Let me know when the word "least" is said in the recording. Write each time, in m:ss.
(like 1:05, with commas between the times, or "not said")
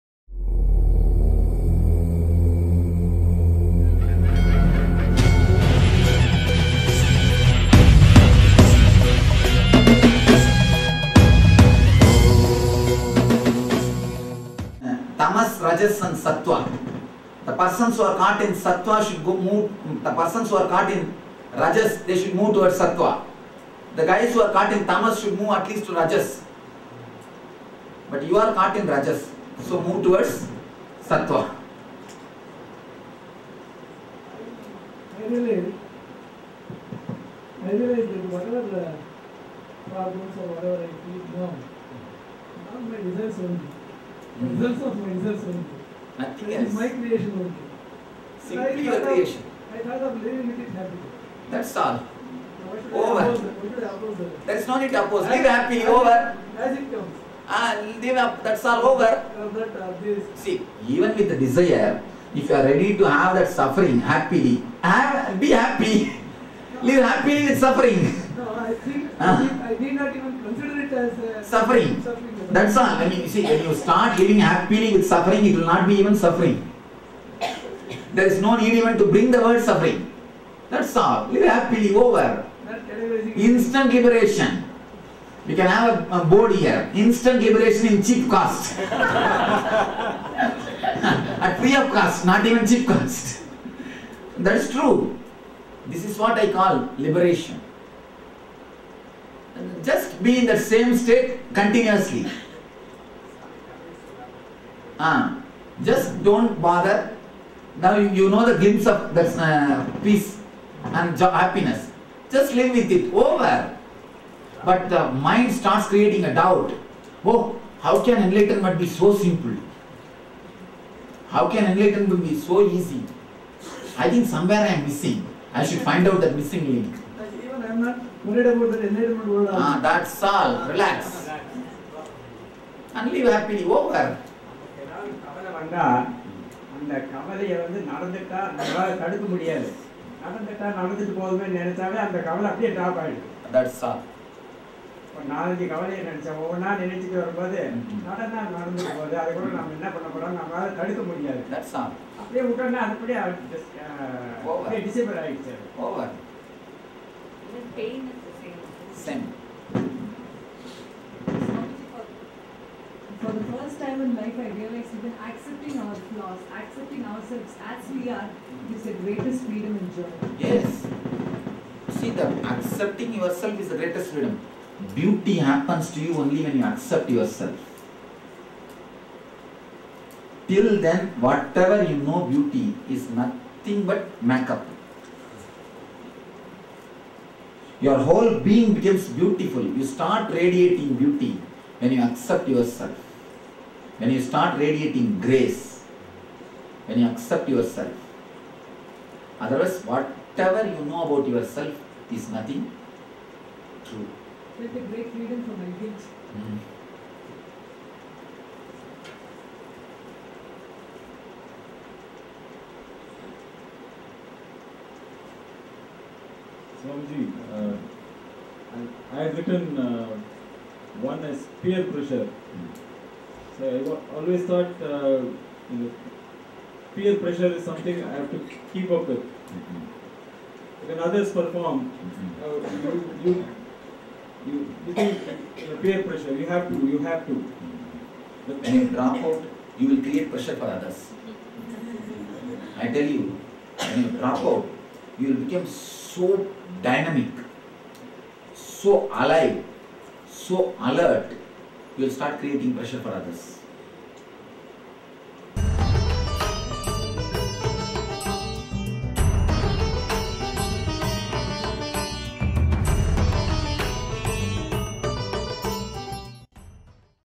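0:25.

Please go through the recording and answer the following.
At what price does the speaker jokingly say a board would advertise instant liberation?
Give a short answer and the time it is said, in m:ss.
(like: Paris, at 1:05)
Free of cost, at 1:31.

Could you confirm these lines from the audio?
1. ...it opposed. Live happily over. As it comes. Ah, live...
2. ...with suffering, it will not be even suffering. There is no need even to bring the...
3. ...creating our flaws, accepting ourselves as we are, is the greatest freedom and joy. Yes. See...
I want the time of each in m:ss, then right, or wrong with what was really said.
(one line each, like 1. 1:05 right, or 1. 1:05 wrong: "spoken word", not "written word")
1. 0:54 right
2. 1:14 right
3. 2:45 wrong: "accepting", not "creating".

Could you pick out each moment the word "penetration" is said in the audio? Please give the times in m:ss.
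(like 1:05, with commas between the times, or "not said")
not said.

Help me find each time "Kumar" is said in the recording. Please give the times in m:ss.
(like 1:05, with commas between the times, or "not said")
not said.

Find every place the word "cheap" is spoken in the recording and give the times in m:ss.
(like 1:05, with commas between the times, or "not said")
1:28, 1:32.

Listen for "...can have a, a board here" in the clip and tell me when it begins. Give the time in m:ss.
1:25.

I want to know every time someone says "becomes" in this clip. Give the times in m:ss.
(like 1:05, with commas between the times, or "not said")
3:08, 4:05.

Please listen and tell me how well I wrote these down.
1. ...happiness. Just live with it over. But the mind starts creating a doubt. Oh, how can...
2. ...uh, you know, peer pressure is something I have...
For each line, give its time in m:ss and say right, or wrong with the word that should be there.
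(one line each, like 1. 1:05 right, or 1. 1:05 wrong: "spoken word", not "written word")
1. 1:51 right
2. 3:44 right.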